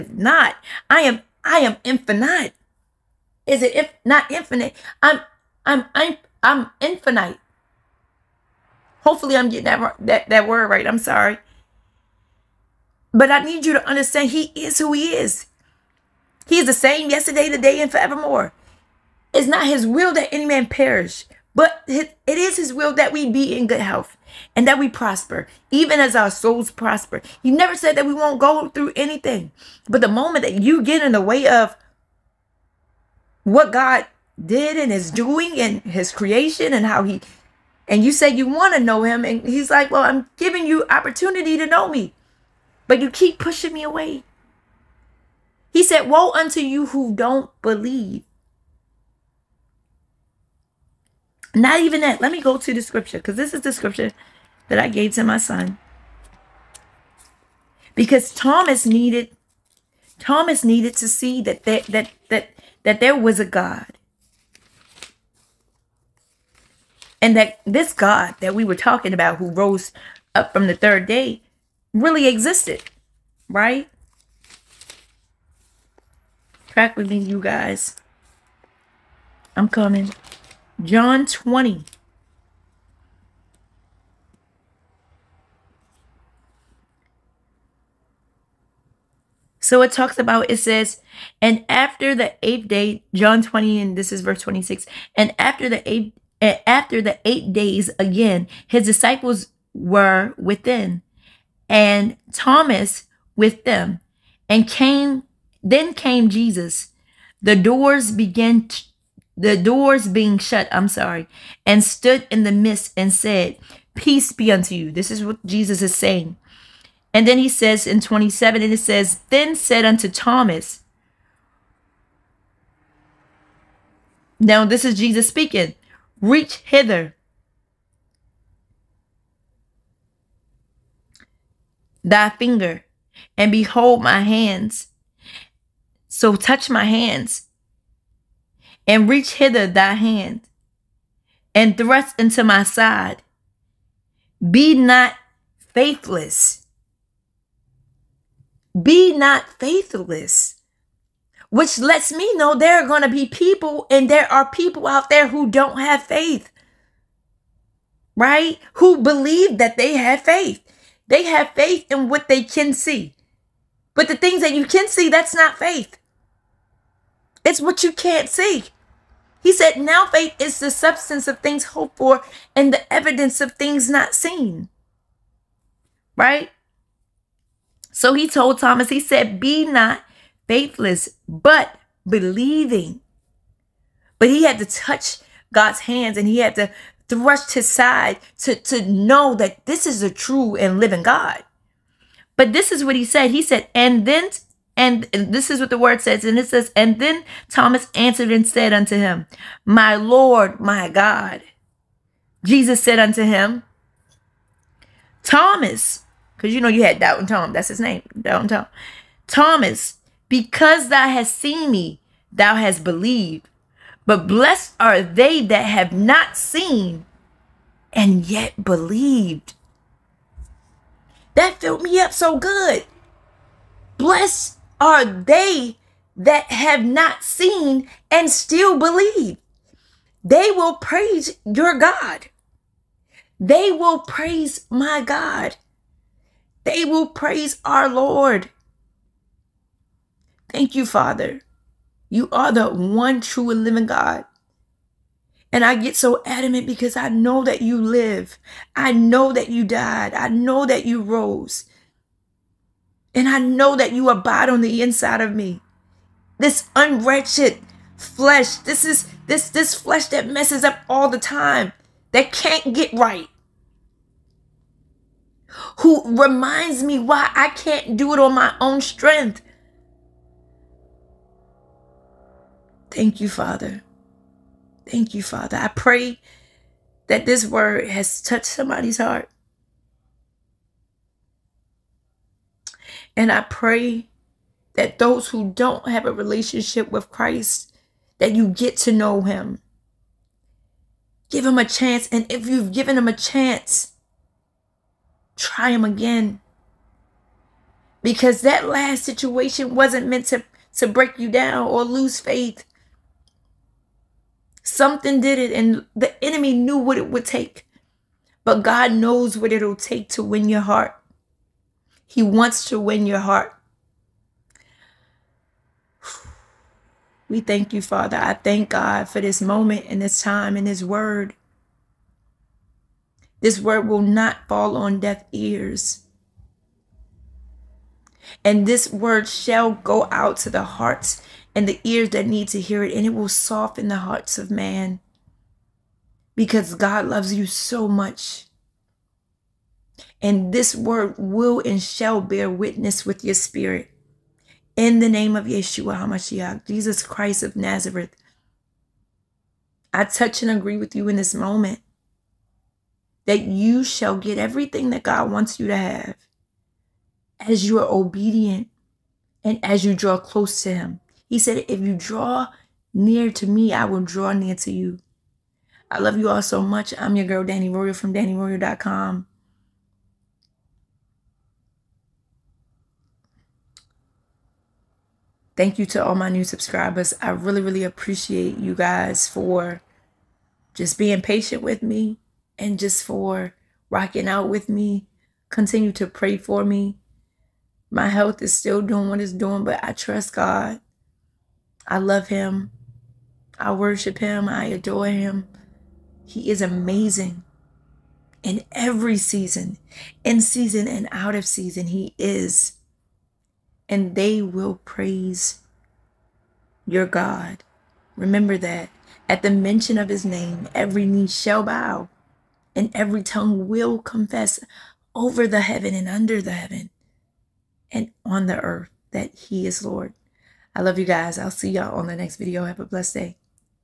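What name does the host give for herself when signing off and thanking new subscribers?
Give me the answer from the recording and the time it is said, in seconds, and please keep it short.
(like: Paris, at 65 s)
Danni Royal, at 367 s.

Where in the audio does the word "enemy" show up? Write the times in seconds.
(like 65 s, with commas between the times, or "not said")
306 s.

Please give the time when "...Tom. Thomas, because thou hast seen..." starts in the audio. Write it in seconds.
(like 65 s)
208 s.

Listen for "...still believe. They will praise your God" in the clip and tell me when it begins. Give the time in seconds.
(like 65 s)
228 s.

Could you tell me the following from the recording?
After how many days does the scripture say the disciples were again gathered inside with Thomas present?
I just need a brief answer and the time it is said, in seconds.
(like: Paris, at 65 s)
8, at 97 s.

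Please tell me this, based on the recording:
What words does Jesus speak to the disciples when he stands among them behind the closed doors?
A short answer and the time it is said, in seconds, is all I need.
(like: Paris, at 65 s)
Peace be unto you, at 113 s.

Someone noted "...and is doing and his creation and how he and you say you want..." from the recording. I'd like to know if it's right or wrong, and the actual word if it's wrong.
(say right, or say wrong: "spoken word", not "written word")
right.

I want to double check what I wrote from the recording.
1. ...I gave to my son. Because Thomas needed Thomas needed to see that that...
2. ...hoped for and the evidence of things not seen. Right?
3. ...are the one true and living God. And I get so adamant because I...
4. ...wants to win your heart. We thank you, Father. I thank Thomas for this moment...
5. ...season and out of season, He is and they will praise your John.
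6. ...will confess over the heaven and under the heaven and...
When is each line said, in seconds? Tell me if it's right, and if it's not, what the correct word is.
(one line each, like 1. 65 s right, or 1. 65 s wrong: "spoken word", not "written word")
1. 54 s right
2. 171 s right
3. 242 s right
4. 312 s wrong: "God", not "Thomas"
5. 400 s wrong: "God", not "John"
6. 413 s right.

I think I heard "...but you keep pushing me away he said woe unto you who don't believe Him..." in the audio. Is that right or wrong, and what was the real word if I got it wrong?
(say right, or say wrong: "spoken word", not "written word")
wrong: "Not", not "Him".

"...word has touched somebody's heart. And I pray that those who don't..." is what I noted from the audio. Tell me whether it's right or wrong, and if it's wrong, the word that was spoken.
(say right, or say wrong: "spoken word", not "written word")
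right.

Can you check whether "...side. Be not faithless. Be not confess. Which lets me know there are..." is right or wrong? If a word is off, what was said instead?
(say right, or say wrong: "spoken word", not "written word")
wrong: "faithless", not "confess".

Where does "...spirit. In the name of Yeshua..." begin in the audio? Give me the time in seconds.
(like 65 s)
343 s.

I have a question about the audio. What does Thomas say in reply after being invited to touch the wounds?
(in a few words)
My Lord, my God.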